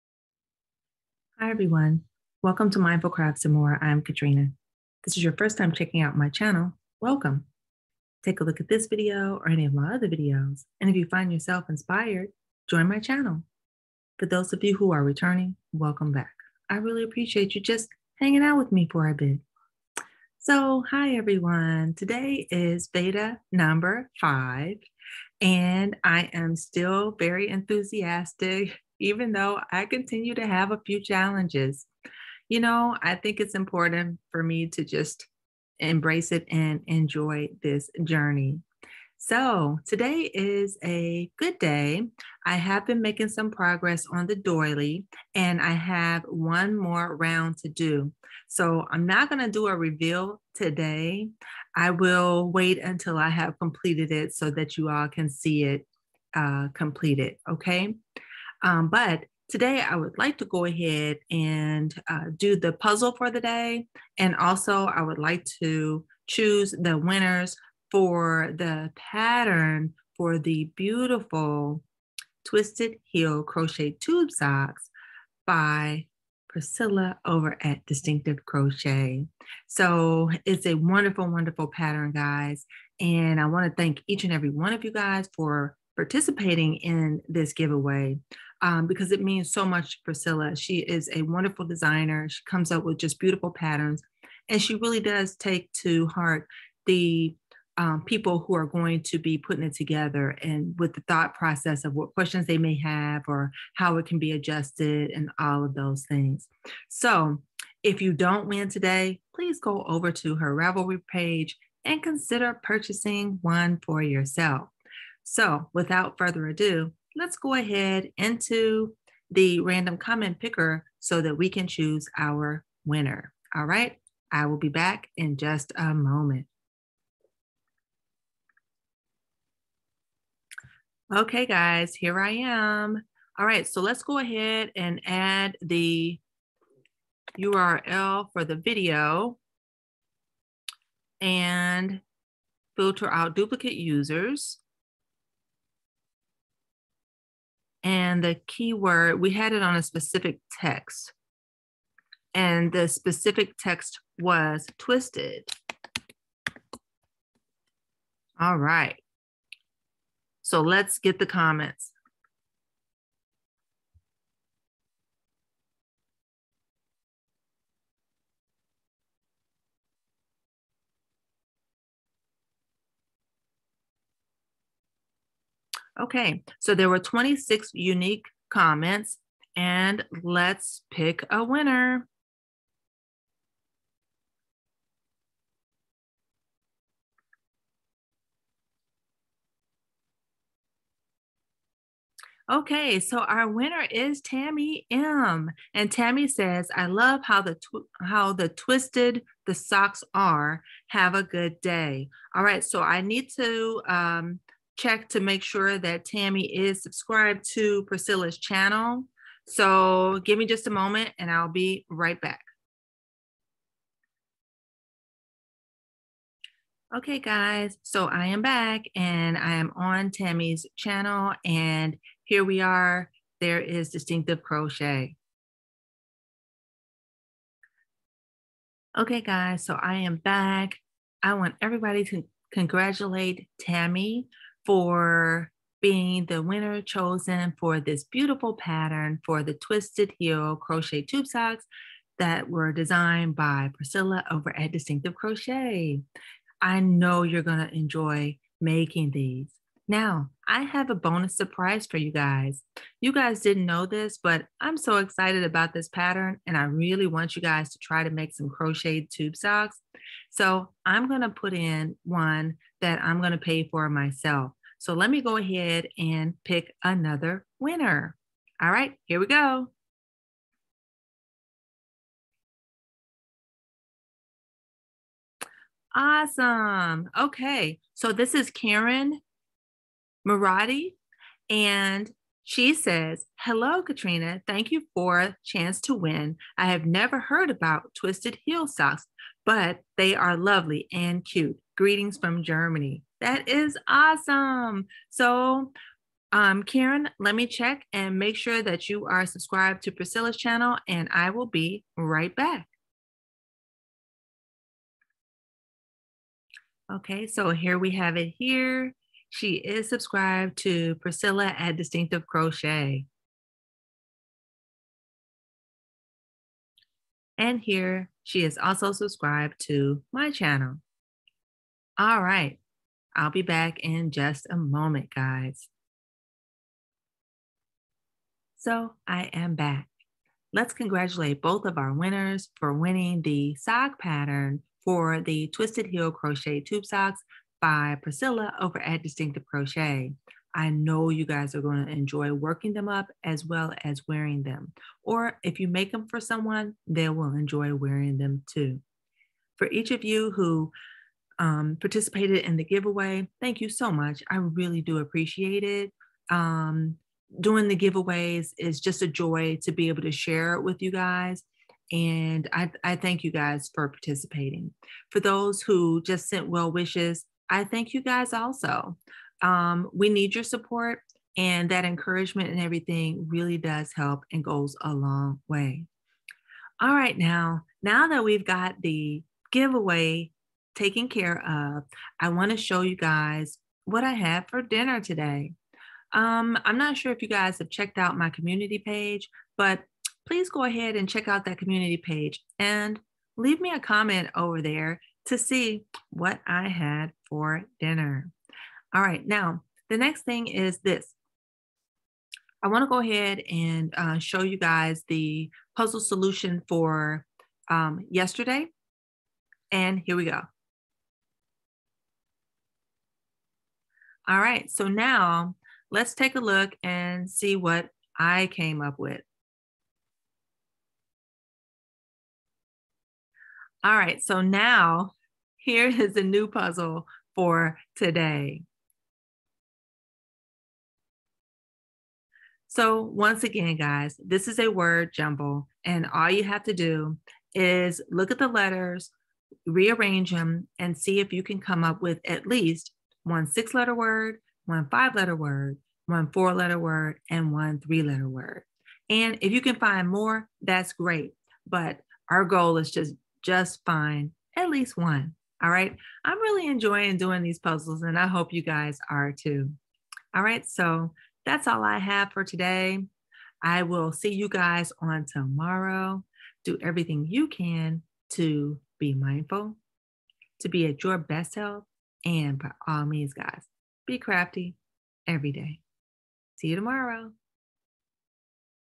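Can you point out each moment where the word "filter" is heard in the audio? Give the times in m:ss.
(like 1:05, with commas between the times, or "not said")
2:22.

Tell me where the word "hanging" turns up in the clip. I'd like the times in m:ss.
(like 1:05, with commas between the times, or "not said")
0:18.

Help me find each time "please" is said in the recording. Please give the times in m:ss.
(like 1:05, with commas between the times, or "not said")
1:49, 6:30.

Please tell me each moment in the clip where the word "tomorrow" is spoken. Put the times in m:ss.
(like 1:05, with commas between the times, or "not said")
7:45, 7:56.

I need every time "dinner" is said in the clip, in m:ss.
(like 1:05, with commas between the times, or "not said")
6:24, 6:37.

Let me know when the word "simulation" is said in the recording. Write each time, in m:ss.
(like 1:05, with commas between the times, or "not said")
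not said.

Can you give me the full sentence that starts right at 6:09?
Um, we need your support, and that encouragement and everything really does help and goes a long way.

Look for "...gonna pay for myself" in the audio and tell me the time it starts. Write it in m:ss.
4:23.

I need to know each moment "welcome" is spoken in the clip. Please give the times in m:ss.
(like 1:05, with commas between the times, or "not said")
0:02, 0:07, 0:15.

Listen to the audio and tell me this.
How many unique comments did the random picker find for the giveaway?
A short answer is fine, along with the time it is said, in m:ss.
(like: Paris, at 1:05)
26, at 2:56.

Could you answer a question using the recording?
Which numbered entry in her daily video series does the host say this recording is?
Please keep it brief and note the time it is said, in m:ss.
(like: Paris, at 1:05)
5, at 0:23.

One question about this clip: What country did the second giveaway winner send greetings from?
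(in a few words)
Germany.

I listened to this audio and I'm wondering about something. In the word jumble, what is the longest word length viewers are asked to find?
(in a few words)
6 letters.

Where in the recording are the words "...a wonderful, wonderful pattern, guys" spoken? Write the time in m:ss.
1:20.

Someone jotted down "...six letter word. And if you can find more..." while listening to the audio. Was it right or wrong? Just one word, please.
wrong.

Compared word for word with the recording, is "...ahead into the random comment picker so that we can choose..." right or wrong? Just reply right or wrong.
right.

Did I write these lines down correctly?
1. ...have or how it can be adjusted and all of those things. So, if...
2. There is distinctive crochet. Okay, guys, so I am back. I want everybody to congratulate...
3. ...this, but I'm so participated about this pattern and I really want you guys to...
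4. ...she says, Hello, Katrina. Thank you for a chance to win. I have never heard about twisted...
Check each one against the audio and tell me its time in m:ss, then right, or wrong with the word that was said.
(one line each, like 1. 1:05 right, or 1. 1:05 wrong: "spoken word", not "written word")
1. 1:42 right
2. 3:43 right
3. 4:13 wrong: "excited", not "participated"
4. 4:42 right.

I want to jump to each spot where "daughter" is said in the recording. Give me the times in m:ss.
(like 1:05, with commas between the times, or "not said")
not said.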